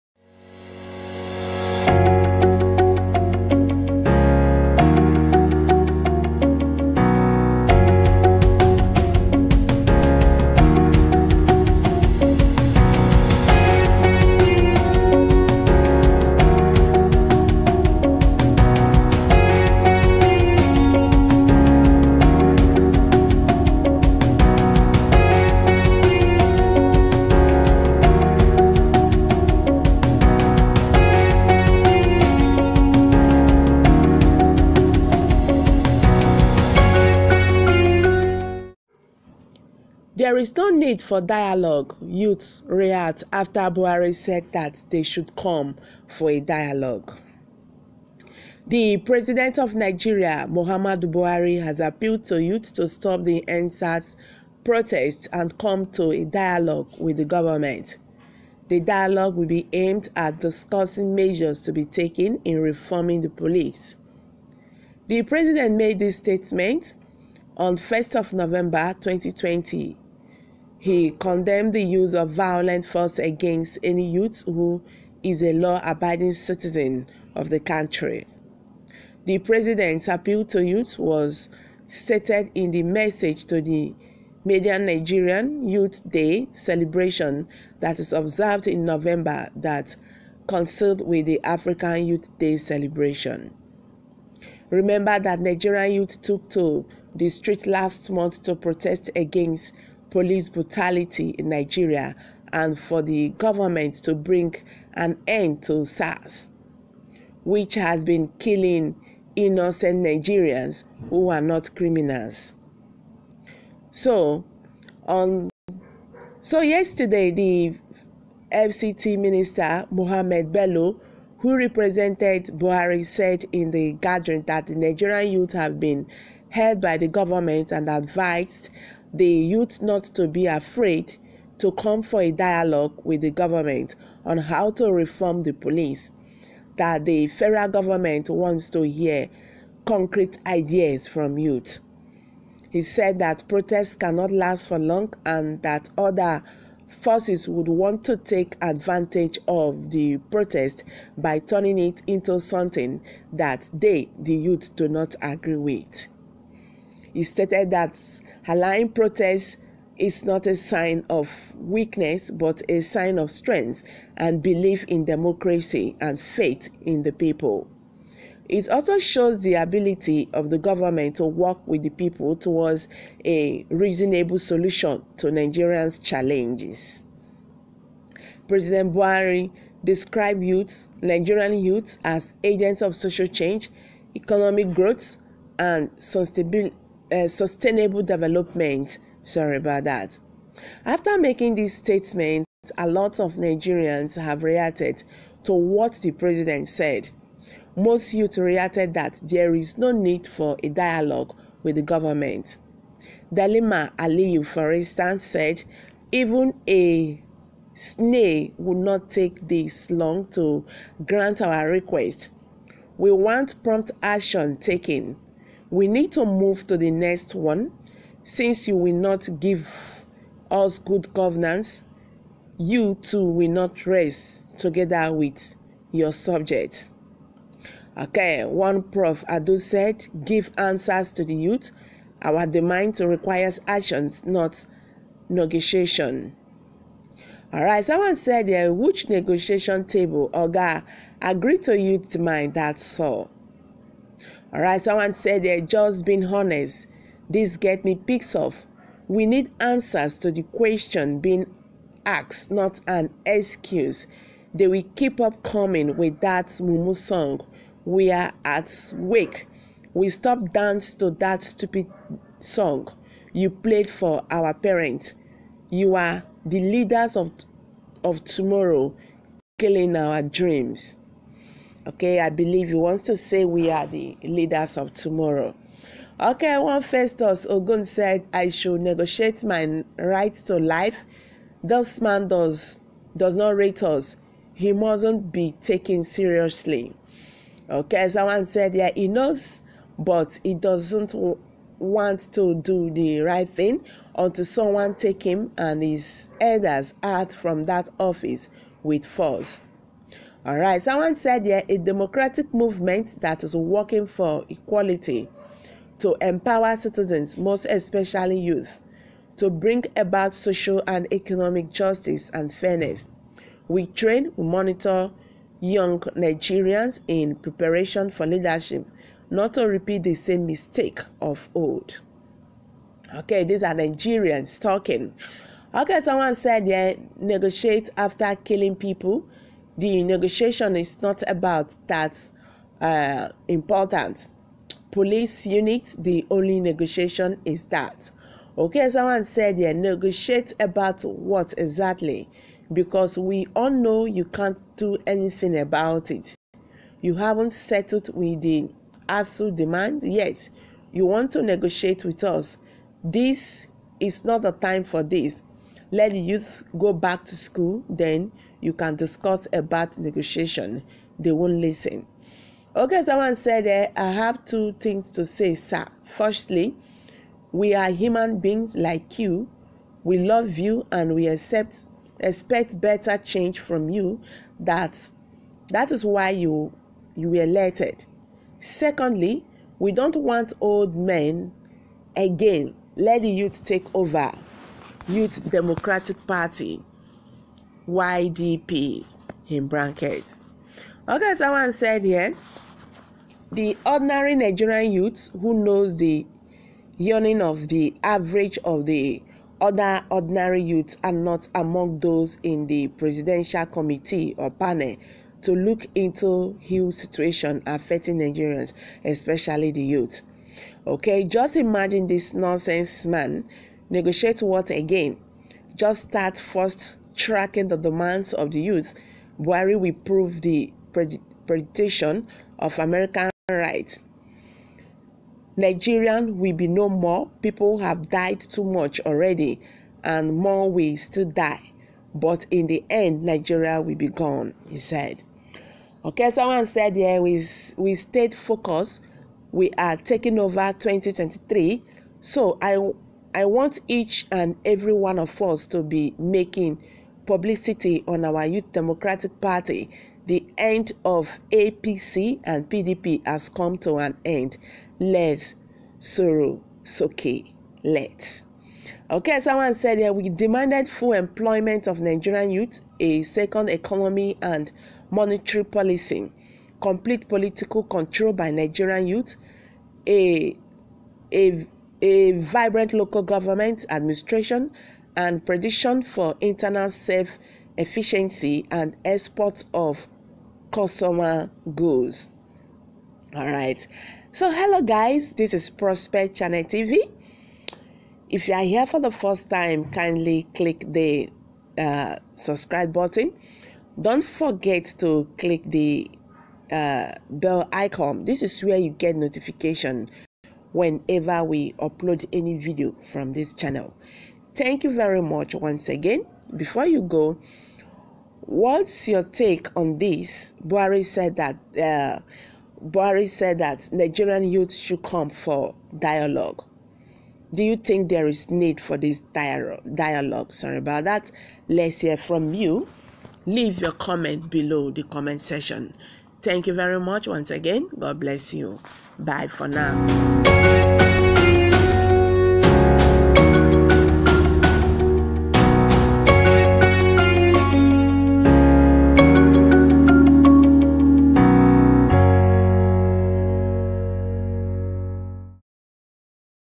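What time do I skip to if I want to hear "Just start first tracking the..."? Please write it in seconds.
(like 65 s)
415 s.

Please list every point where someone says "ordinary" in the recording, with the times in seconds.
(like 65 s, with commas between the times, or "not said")
393 s, 400 s.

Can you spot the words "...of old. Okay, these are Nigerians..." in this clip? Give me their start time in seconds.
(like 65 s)
321 s.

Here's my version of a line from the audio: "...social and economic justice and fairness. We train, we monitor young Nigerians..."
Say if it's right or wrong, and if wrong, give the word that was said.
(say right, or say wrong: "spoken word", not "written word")
right.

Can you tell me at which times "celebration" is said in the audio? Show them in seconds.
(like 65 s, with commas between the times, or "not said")
86 s, 92 s.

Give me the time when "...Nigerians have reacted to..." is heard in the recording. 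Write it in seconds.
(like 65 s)
193 s.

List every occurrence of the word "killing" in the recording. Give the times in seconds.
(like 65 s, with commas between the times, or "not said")
108 s, 269 s, 328 s.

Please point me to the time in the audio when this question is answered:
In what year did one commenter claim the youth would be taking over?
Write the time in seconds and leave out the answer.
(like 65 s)
440 s.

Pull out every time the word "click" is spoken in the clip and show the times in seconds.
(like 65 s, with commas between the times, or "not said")
490 s, 495 s.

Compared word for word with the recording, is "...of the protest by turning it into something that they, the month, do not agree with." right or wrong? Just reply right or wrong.
wrong.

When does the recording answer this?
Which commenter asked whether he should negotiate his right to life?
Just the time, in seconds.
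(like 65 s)
276 s.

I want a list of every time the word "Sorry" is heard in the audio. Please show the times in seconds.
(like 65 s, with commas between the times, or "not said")
189 s, 520 s.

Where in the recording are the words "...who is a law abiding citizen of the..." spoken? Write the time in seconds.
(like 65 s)
74 s.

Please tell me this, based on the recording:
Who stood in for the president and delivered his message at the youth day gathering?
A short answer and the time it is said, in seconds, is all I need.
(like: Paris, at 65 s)
Mohamed Bello, at 119 s.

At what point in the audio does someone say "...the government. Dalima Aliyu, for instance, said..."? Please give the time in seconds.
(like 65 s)
201 s.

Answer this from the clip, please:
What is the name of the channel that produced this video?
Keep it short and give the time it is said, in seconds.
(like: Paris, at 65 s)
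Prospect Channel TV, at 485 s.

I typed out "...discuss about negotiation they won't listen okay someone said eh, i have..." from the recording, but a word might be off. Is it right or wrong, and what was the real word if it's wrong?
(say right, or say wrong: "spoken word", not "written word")
right.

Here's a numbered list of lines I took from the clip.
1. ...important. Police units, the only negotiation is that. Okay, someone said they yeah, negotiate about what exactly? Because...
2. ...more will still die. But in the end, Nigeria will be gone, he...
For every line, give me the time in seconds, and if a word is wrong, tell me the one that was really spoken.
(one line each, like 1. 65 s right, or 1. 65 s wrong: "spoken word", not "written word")
1. 333 s right
2. 430 s right.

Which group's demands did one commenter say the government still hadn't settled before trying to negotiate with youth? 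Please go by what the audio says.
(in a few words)
ASUU.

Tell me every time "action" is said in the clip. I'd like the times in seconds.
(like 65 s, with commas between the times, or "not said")
214 s, 233 s.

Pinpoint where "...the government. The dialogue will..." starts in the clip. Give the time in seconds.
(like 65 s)
57 s.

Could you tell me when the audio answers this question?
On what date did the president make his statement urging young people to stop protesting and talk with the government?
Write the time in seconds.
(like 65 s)
67 s.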